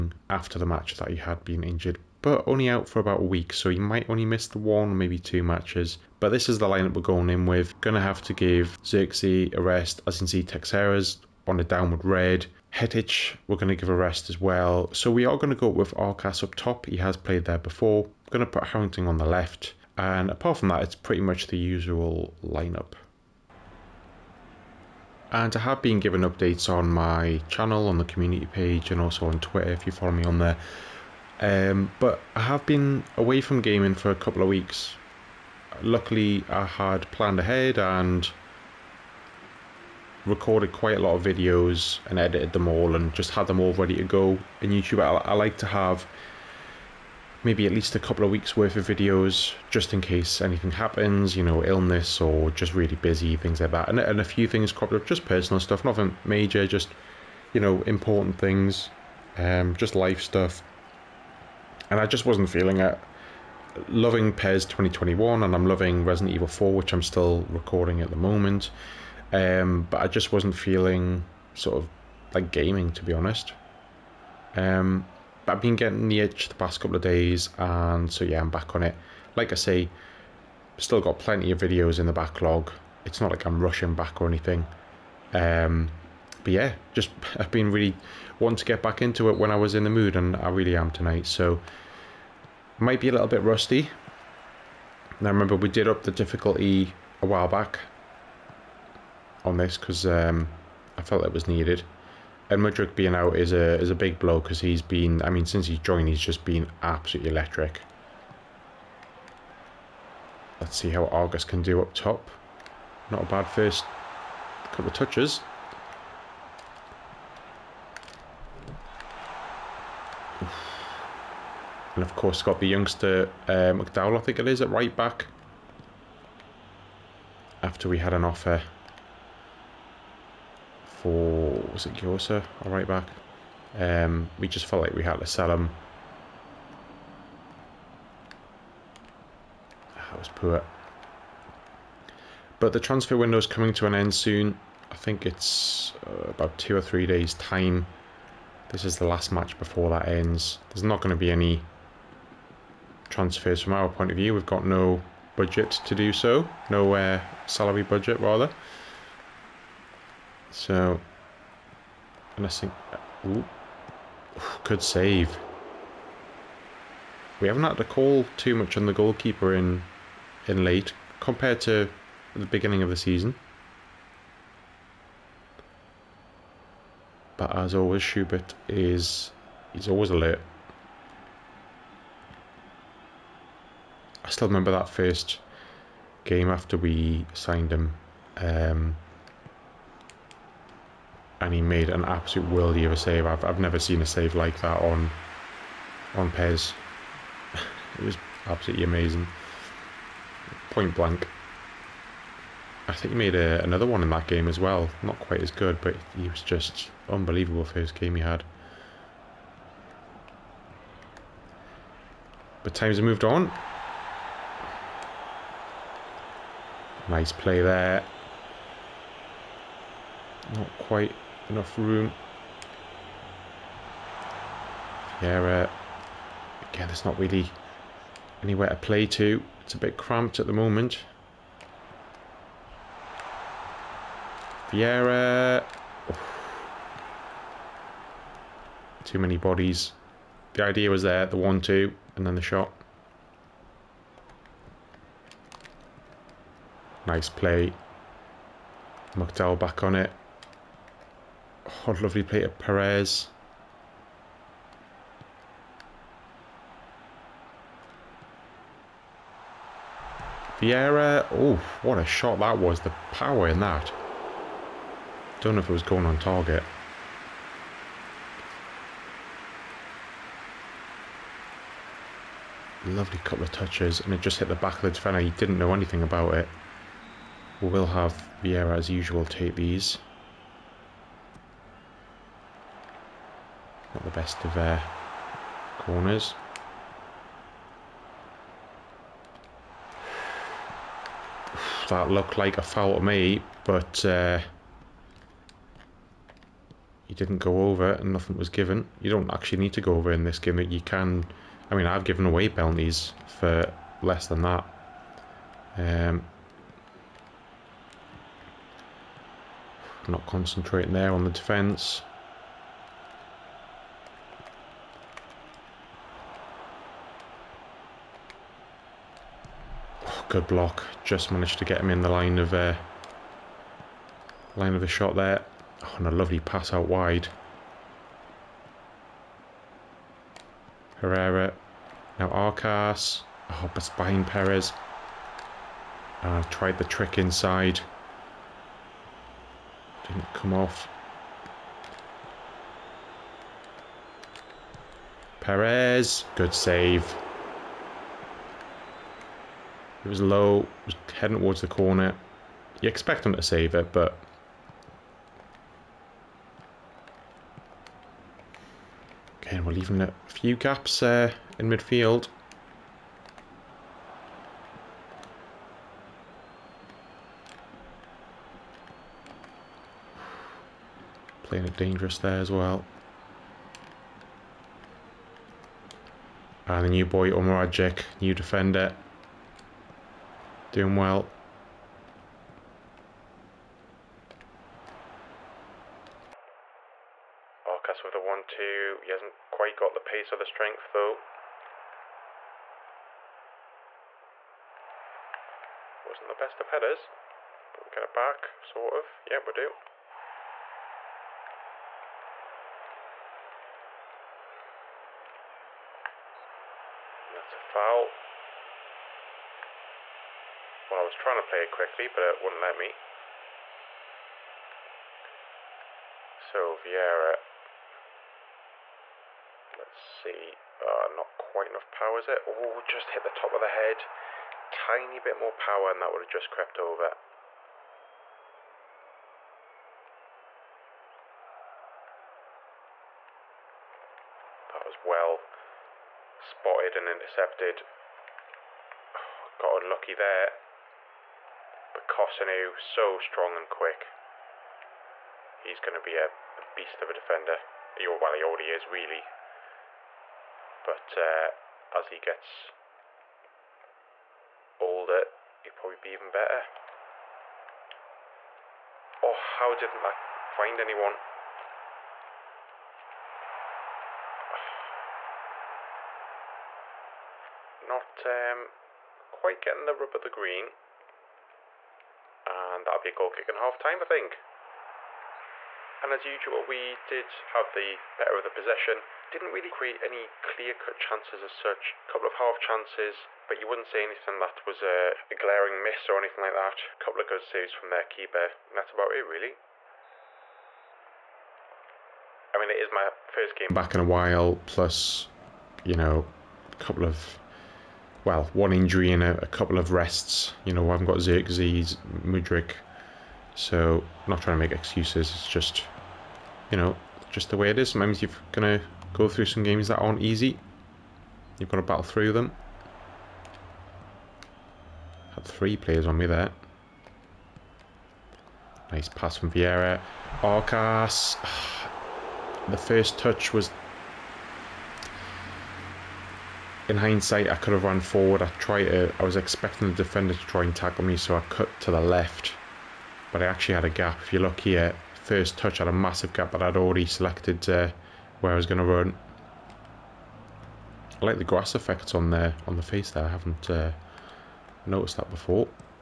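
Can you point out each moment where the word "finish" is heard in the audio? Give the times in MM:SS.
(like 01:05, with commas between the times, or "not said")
not said.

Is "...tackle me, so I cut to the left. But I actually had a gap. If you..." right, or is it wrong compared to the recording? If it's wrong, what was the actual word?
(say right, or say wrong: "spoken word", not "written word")
right.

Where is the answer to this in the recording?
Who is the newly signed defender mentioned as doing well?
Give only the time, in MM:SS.
06:17.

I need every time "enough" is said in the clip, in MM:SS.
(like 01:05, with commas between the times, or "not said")
03:41, 07:01.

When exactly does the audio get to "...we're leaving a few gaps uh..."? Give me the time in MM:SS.
05:59.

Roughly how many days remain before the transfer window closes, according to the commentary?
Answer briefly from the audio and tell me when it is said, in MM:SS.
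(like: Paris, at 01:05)
2 or 3 days, at 02:26.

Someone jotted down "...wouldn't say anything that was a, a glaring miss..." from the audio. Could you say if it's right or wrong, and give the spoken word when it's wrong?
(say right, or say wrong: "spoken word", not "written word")
right.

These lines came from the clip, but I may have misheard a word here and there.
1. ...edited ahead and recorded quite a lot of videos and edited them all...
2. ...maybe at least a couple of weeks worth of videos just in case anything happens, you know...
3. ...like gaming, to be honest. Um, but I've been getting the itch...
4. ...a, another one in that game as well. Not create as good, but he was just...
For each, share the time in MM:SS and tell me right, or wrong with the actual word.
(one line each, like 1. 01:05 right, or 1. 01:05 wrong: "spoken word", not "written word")
1. 00:37 wrong: "planned", not "edited"
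2. 00:47 right
3. 01:12 right
4. 03:23 wrong: "quite", not "create".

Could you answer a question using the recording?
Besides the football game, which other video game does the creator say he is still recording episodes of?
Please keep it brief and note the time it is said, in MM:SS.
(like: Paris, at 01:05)
Resident Evil 4, at 01:06.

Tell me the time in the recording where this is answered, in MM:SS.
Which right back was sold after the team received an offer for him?
02:11.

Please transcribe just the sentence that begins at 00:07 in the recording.
Gonna have to give Xerxes a rest, as in see Texeras on a downward red.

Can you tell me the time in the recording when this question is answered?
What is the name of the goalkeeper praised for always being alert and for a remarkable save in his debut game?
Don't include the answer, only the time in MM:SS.
02:58.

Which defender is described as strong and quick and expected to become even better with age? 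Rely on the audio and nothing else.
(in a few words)
Kosanu.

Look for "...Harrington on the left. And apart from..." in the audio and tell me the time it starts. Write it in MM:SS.
00:18.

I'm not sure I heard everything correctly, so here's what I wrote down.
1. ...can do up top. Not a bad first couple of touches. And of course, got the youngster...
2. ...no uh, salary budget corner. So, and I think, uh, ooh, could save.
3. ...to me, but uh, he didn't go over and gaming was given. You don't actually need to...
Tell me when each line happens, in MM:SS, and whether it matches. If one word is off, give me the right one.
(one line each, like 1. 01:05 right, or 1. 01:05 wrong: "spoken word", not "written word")
1. 01:51 right
2. 02:36 wrong: "rather", not "corner"
3. 04:52 wrong: "nothing", not "gaming".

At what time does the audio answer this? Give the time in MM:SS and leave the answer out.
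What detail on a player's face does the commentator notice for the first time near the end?
09:01.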